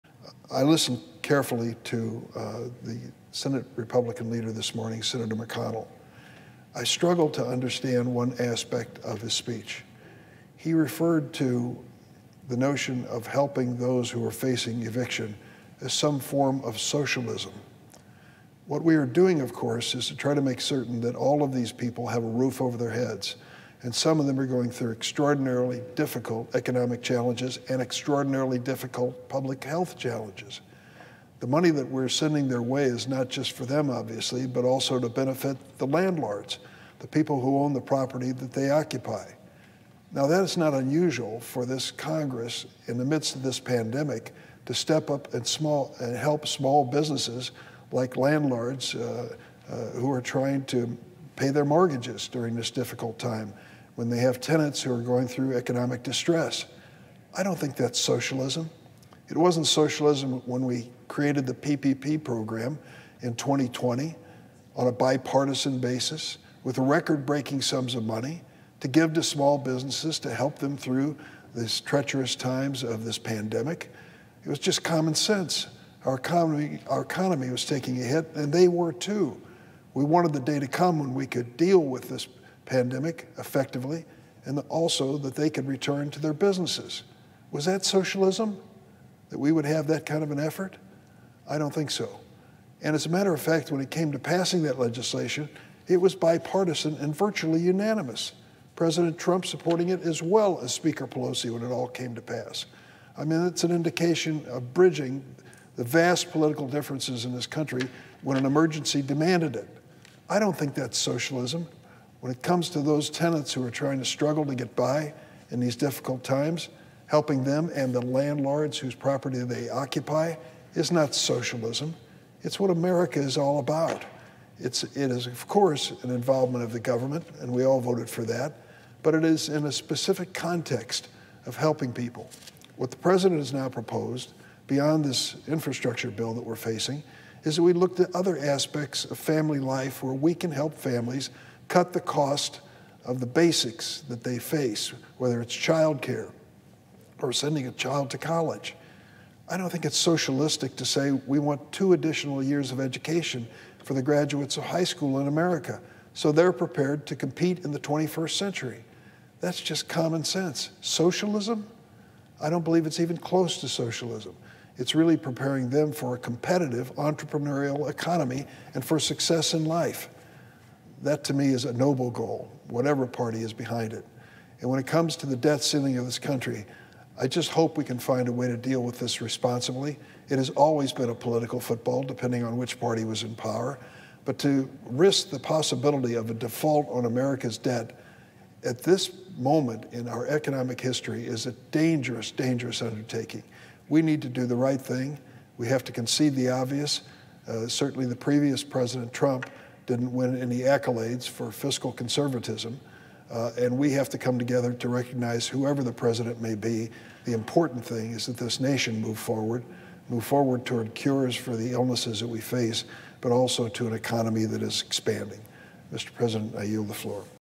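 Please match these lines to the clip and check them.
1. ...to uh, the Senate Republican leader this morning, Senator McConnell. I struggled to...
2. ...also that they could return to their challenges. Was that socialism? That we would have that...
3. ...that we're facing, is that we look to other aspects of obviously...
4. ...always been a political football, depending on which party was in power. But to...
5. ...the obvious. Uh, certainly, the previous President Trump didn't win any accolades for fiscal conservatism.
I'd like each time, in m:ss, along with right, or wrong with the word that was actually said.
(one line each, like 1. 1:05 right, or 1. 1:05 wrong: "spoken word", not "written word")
1. 0:01 right
2. 1:24 wrong: "businesses", not "challenges"
3. 2:16 wrong: "family", not "obviously"
4. 3:00 right
5. 3:16 right.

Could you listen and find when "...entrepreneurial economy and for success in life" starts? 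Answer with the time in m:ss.
2:46.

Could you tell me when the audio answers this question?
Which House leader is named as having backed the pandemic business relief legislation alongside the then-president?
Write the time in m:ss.
1:40.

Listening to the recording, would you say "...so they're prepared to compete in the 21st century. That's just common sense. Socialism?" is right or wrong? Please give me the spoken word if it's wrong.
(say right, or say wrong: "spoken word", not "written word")
right.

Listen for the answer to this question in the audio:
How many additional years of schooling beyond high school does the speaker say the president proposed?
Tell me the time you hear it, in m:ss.
2:31.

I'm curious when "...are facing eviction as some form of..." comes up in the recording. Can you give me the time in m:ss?
0:14.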